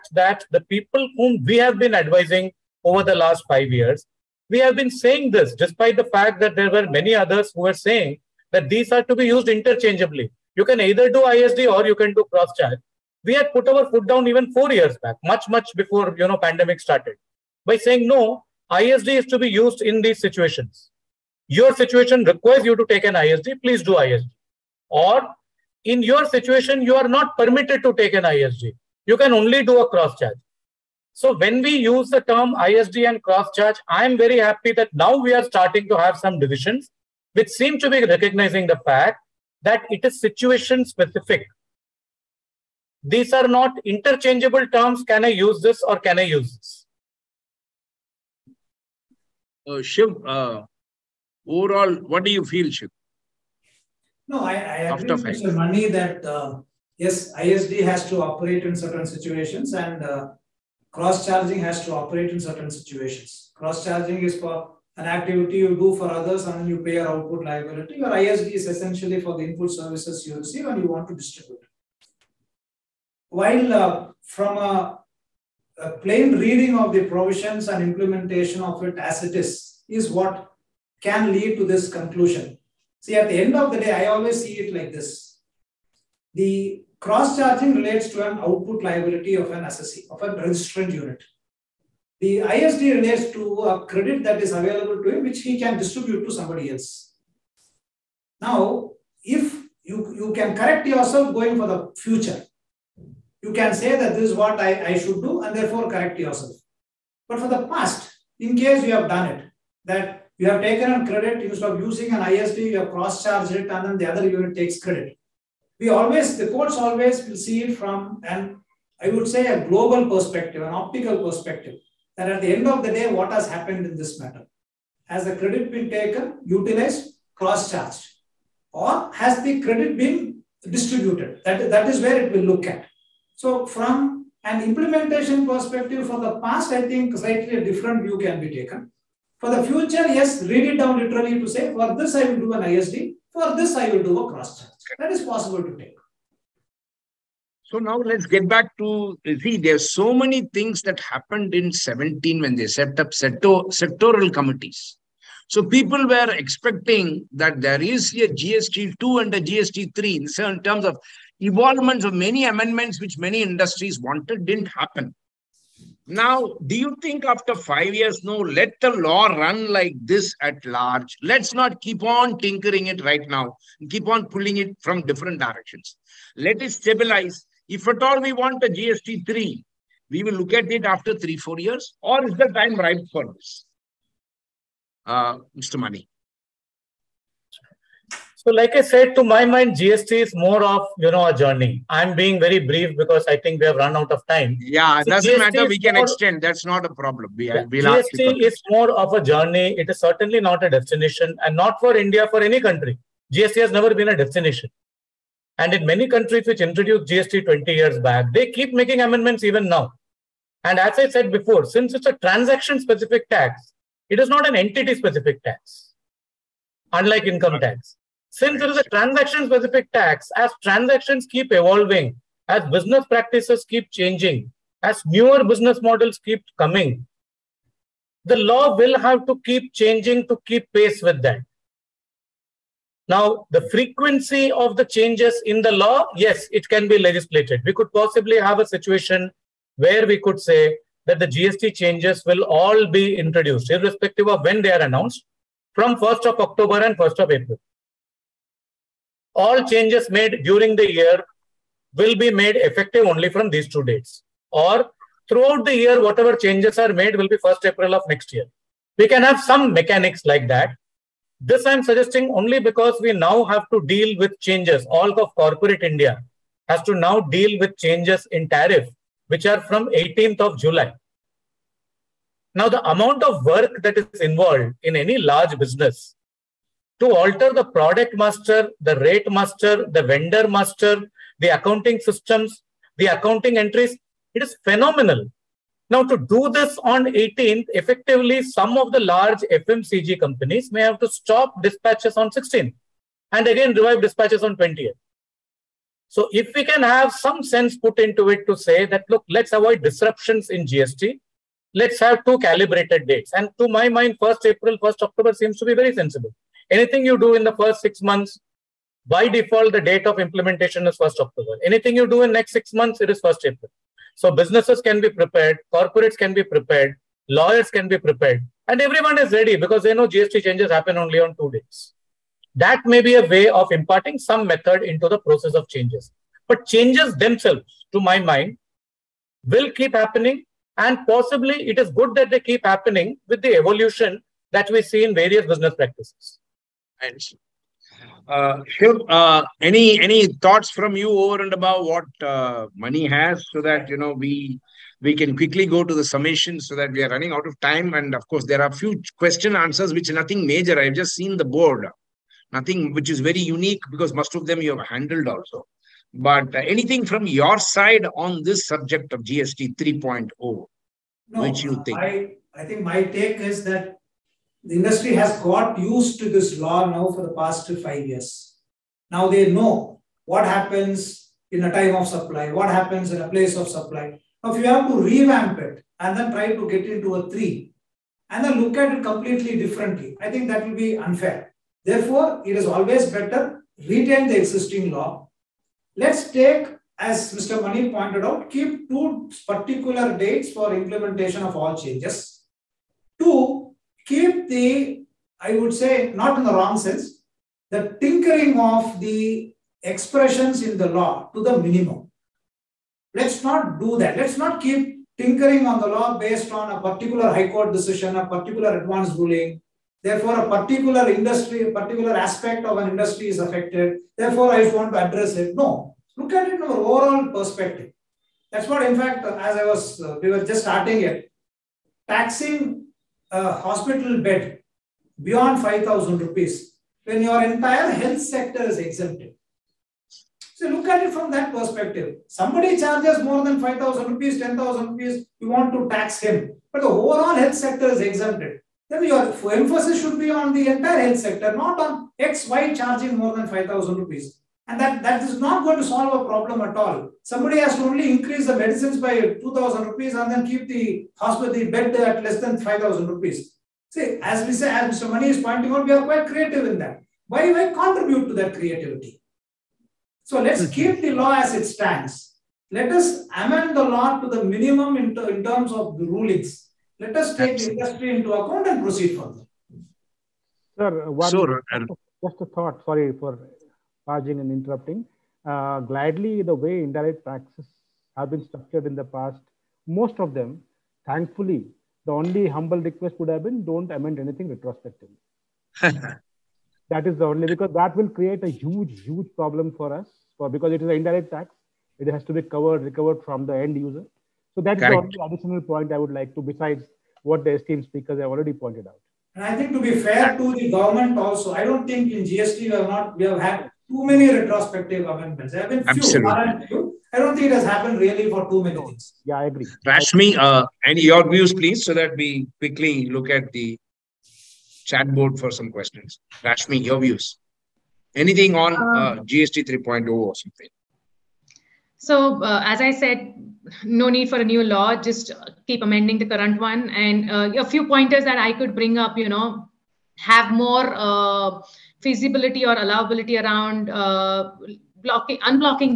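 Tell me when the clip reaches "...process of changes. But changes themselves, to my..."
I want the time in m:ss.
5:25.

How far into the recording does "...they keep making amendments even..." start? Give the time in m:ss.
3:28.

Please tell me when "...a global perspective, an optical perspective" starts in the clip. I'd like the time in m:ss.
1:59.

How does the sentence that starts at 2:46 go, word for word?
Now, do you think after five years, no, let the law run like this at large?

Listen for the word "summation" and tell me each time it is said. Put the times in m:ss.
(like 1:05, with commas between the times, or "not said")
5:46.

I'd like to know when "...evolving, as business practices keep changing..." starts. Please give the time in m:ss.
3:41.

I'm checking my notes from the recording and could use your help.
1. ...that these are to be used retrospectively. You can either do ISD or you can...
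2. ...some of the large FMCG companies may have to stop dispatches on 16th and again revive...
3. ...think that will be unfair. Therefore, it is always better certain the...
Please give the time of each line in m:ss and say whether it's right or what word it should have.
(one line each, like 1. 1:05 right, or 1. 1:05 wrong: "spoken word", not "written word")
1. 0:08 wrong: "interchangeably", not "retrospectively"
2. 4:48 right
3. 6:20 wrong: "retain", not "certain".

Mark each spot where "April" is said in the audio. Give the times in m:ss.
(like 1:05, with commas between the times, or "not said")
4:07, 4:17, 5:04, 5:13.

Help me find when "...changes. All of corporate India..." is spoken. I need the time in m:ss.
4:24.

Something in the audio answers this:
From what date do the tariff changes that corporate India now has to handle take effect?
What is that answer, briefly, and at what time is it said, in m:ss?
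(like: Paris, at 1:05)
18th of July, at 4:29.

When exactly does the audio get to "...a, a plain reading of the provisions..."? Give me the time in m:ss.
1:14.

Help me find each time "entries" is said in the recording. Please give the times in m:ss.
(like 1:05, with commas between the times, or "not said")
4:43.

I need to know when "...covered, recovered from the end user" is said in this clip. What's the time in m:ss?
8:12.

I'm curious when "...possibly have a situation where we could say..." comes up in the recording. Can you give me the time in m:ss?
3:57.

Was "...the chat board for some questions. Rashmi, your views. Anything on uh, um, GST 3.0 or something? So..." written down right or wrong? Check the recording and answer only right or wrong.
right.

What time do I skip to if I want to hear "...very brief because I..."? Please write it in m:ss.
3:12.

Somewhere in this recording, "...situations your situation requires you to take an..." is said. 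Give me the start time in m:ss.
0:20.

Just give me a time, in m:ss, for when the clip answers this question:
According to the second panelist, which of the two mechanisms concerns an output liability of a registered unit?
1:26.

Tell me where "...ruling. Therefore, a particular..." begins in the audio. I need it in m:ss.
6:49.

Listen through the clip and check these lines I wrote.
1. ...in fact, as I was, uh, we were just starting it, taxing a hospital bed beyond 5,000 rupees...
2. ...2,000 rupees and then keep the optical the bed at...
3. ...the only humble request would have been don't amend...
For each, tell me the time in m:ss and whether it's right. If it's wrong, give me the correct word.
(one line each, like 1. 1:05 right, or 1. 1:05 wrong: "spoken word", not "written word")
1. 6:58 right
2. 7:29 wrong: "hospital", not "optical"
3. 8:02 right.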